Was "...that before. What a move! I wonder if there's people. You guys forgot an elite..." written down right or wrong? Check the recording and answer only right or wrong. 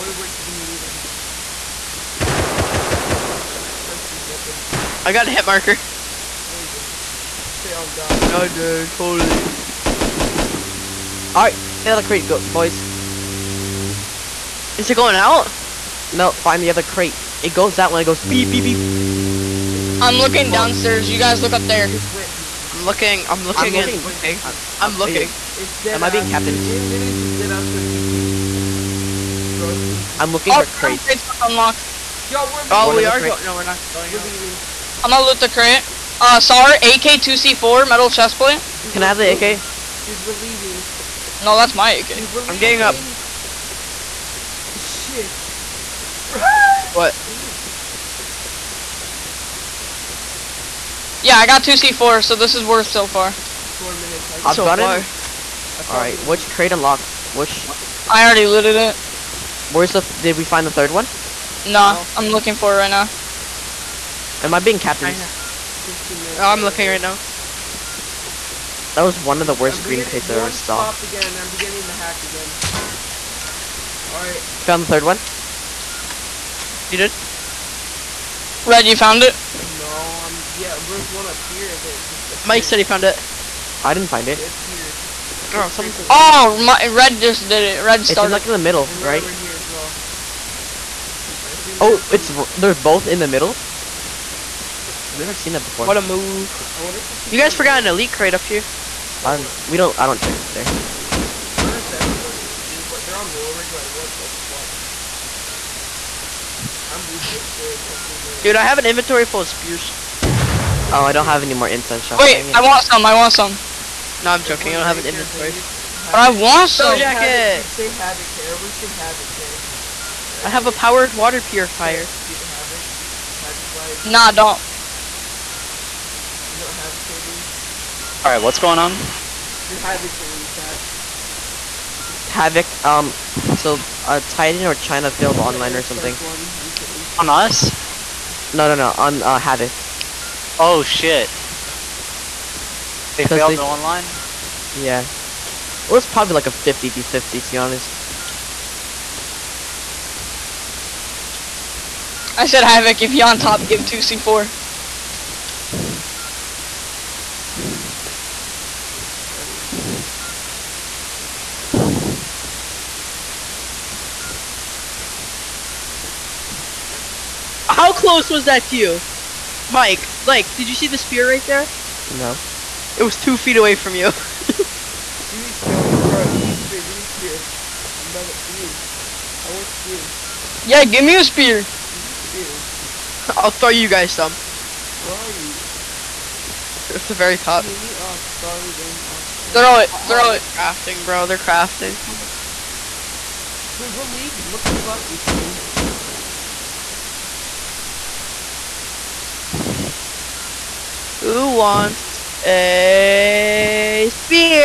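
right.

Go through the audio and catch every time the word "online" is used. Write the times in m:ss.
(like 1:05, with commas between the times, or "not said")
2:15, 2:23.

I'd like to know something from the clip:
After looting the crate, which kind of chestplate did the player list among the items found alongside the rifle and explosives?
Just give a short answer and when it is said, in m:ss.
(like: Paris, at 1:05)
Metal, at 0:37.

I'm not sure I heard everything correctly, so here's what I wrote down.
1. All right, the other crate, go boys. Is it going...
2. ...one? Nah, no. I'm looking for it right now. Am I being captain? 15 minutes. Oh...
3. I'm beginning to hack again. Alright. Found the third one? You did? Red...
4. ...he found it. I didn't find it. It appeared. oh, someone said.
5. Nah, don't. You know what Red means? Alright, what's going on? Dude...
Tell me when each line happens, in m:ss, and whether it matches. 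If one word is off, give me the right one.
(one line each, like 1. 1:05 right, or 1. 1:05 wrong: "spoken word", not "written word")
1. 0:11 right
2. 1:00 right
3. 1:11 right
4. 1:22 right
5. 2:04 wrong: "Havoc", not "Red".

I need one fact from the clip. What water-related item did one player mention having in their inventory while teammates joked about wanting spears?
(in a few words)
Powered water purifier.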